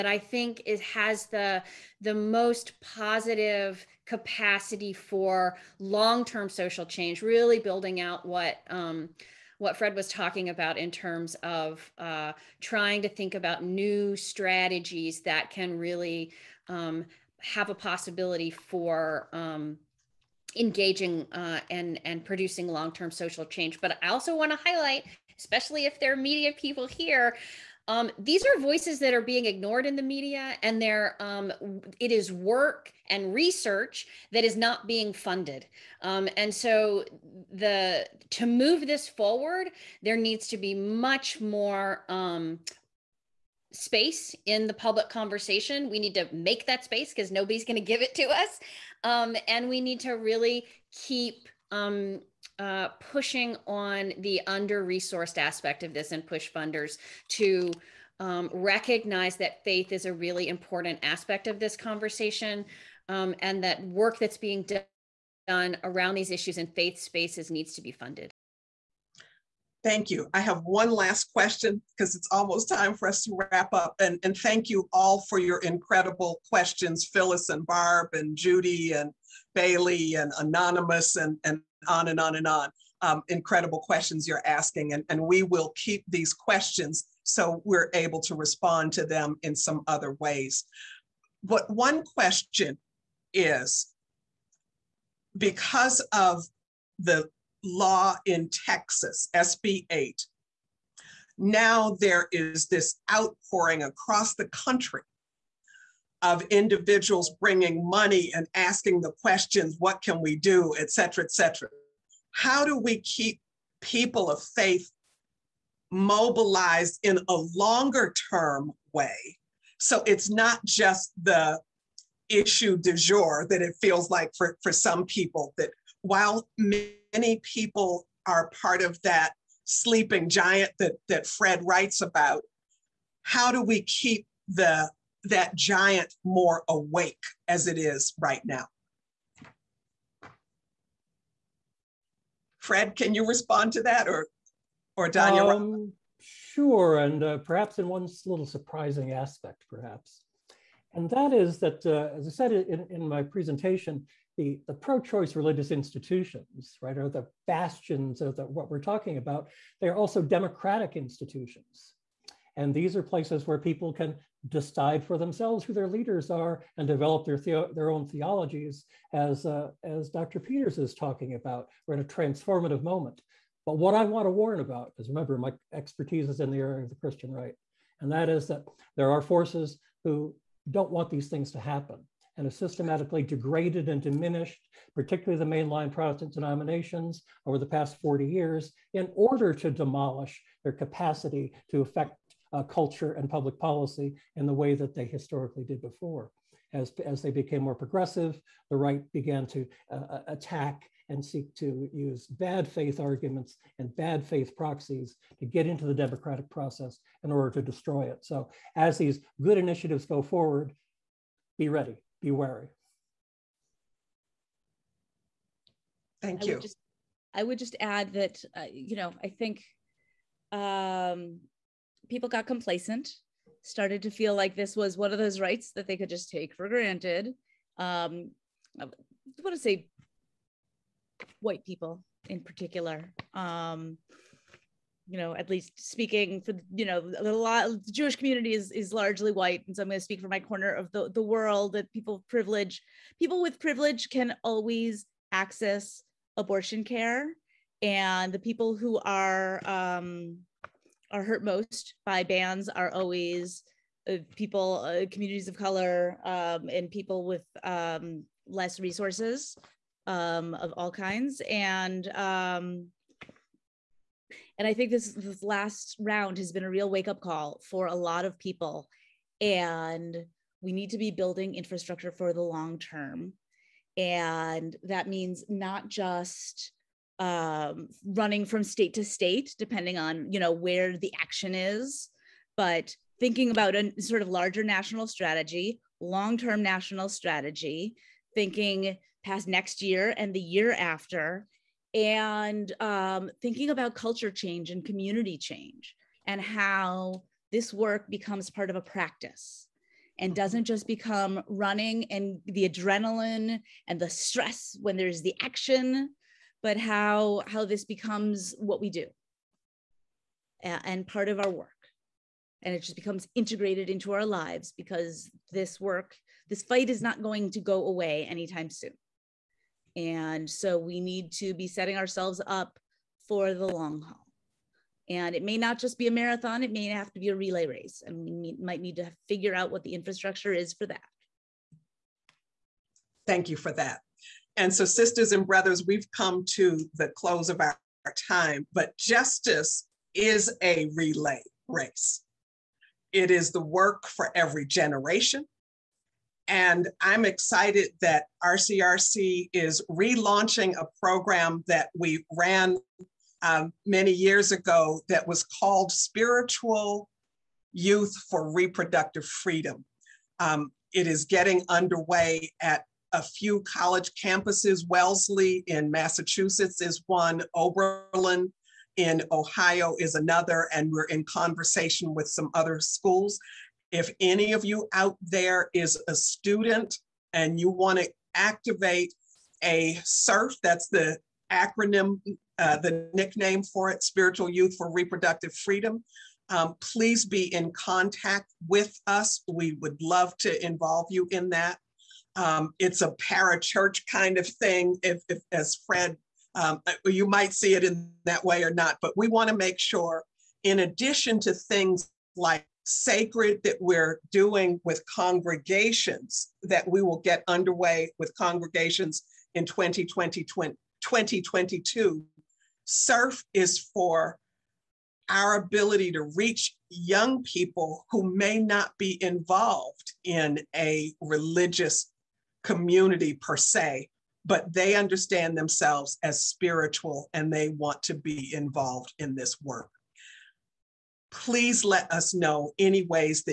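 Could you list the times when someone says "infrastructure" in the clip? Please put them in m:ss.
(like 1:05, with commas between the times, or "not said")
4:31, 5:29.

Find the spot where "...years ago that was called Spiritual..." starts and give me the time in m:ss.
5:54.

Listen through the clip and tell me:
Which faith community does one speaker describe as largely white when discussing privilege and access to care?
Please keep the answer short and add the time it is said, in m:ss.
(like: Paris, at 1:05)
Jewish community, at 3:57.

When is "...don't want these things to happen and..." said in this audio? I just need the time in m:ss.
3:00.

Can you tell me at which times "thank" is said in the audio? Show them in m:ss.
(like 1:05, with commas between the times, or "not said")
1:09, 1:14, 3:36, 5:33.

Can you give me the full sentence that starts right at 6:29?
We would love to involve you in that.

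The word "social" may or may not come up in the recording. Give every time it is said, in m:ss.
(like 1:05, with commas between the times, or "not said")
0:06, 0:23.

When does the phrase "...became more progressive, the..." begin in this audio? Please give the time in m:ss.
3:17.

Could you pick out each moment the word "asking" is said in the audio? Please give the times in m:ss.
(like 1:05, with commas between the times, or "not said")
1:24, 1:48.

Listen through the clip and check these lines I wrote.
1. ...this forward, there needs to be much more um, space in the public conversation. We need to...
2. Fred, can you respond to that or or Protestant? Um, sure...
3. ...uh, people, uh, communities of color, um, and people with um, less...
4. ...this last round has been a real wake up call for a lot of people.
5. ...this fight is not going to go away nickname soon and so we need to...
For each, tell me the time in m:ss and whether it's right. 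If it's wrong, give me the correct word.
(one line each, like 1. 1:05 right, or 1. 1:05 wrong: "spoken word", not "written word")
1. 0:38 right
2. 2:22 wrong: "Danya", not "Protestant"
3. 4:14 right
4. 4:25 right
5. 5:16 wrong: "anytime", not "nickname".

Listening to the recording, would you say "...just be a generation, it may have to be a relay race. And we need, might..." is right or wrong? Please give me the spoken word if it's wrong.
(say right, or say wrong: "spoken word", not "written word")
wrong: "marathon", not "generation".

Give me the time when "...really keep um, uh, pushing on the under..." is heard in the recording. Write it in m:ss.
0:50.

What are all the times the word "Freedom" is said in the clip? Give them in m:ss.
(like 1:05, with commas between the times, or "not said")
5:59, 6:25.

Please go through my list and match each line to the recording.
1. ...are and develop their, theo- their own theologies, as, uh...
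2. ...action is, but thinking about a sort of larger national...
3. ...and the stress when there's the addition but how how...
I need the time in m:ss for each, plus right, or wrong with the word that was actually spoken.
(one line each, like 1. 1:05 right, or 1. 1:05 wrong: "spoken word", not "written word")
1. 2:46 right
2. 4:41 right
3. 5:03 wrong: "action", not "addition".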